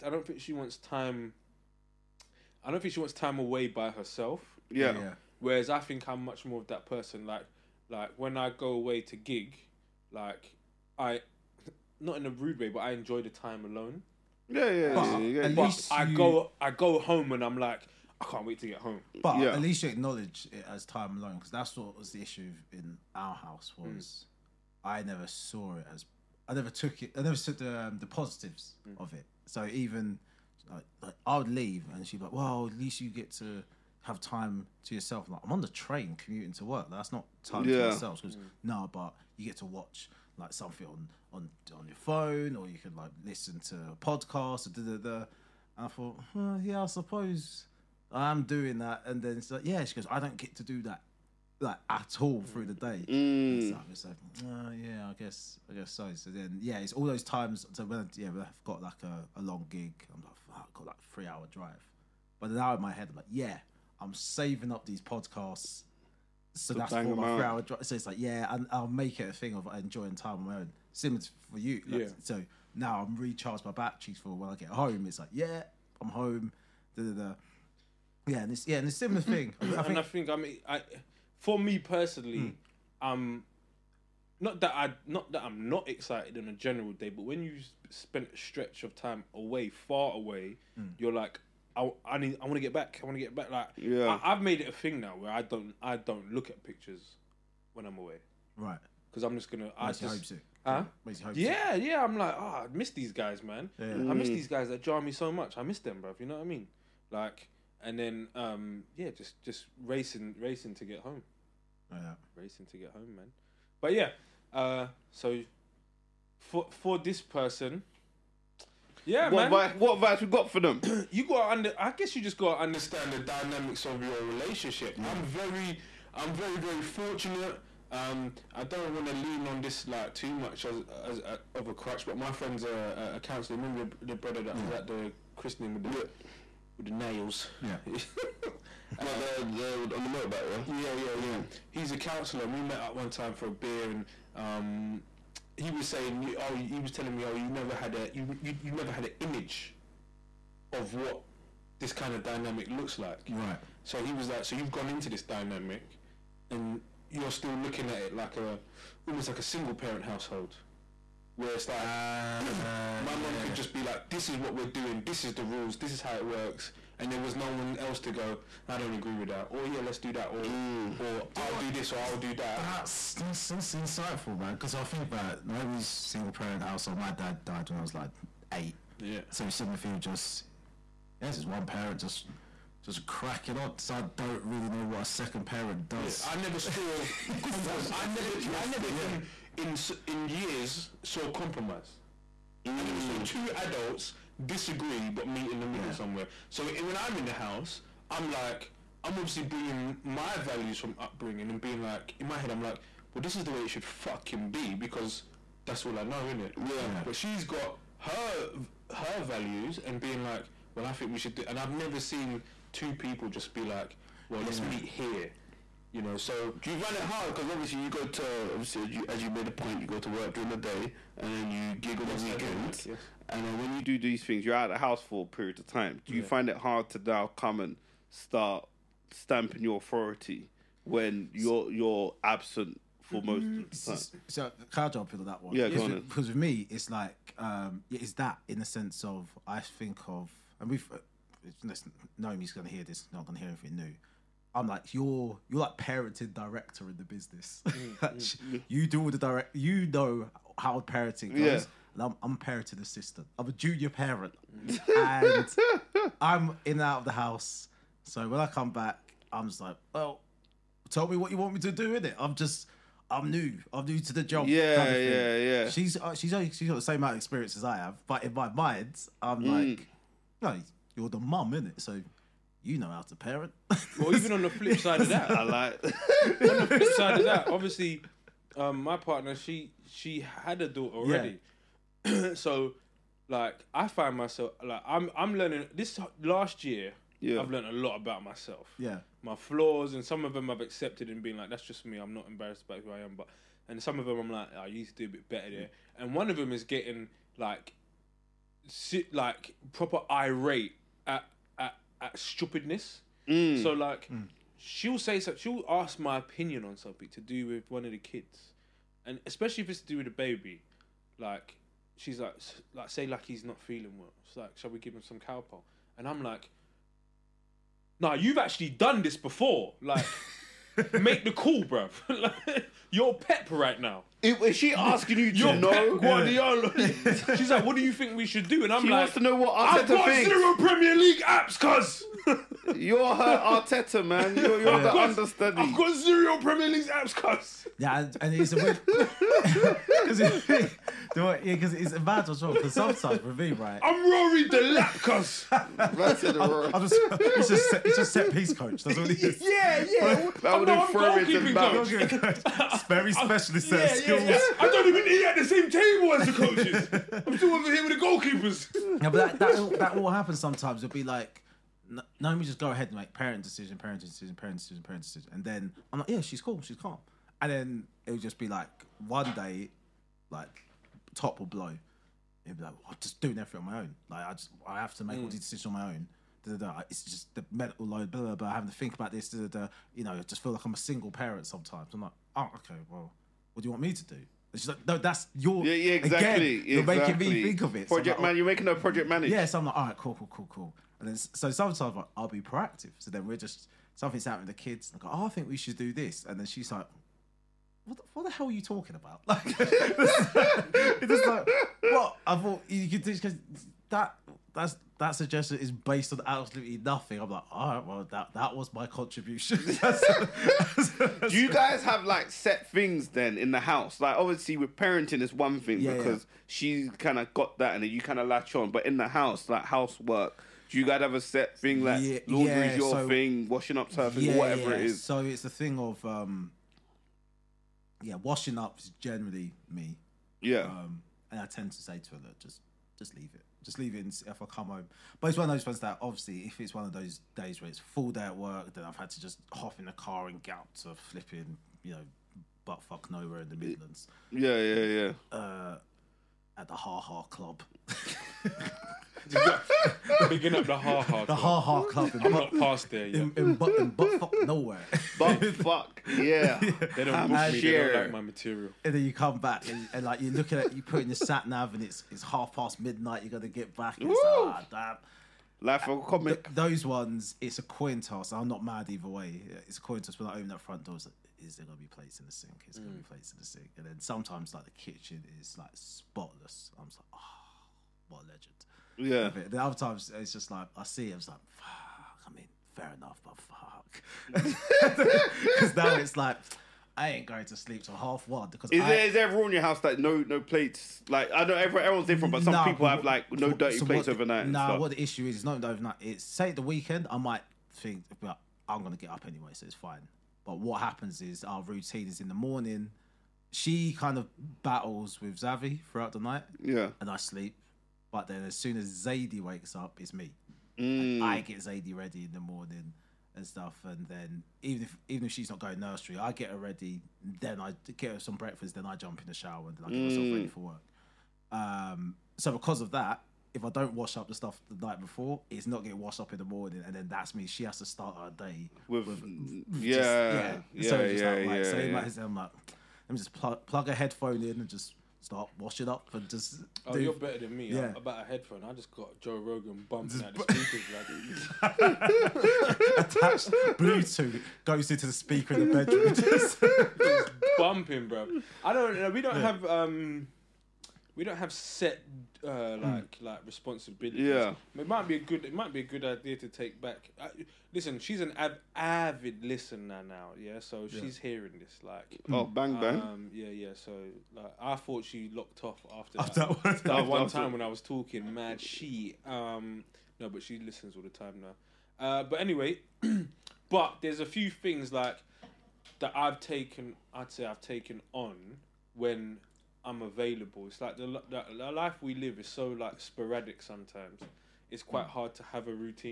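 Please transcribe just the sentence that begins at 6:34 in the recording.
I go, oh, I think we should do this.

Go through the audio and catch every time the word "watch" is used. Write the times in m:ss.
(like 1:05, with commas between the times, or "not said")
0:39.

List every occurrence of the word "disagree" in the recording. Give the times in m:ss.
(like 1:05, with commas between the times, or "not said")
3:14.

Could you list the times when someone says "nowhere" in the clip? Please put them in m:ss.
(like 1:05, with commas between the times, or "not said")
7:23, 7:34.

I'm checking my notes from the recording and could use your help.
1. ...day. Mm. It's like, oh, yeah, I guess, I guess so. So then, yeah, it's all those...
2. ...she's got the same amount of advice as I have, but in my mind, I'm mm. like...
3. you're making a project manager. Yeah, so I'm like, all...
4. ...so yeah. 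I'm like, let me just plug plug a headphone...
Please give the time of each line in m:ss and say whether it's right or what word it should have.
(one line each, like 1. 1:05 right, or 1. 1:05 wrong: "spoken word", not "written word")
1. 0:52 right
2. 4:26 wrong: "experience", not "advice"
3. 6:28 right
4. 8:52 right.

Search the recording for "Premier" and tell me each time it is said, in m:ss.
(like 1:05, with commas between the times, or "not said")
5:30, 5:36.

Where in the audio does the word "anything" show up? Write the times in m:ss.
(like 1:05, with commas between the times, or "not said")
4:03.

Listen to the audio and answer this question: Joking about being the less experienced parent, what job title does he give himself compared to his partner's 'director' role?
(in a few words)
Parenting assistant.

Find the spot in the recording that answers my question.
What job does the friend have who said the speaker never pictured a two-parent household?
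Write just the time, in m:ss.
2:13.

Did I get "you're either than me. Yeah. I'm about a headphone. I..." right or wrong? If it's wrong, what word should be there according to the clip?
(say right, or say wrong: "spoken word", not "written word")
wrong: "better", not "either".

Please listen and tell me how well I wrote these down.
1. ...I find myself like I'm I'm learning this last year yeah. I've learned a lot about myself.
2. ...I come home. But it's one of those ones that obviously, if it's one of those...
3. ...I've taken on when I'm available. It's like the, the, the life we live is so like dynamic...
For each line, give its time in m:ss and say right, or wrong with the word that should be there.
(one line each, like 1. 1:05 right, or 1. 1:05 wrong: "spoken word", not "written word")
1. 4:43 right
2. 7:14 right
3. 9:37 wrong: "sporadic", not "dynamic".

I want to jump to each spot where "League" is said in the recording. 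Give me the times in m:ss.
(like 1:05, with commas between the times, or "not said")
5:30, 5:36.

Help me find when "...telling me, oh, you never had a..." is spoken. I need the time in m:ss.
2:26.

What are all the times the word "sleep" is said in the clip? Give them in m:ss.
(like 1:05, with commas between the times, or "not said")
8:07, 8:27.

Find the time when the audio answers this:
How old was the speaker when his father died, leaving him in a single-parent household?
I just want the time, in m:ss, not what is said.
2:58.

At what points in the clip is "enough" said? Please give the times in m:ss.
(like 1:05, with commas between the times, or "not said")
8:02.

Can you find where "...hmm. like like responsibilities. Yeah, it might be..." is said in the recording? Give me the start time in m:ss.
9:12.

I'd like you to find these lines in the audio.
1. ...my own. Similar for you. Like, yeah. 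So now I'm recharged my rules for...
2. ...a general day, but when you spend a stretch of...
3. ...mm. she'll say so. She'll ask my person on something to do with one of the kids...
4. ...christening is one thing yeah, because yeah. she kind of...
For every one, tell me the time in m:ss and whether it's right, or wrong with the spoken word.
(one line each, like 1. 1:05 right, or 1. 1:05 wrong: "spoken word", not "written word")
1. 1:10 wrong: "batteries", not "rules"
2. 1:26 right
3. 5:04 wrong: "opinion", not "person"
4. 6:54 wrong: "parenting", not "christening".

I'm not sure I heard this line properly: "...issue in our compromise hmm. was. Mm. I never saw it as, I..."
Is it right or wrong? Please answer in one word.
wrong.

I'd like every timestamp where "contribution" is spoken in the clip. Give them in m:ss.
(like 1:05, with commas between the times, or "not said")
6:48.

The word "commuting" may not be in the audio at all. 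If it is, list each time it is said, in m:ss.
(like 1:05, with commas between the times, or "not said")
0:36.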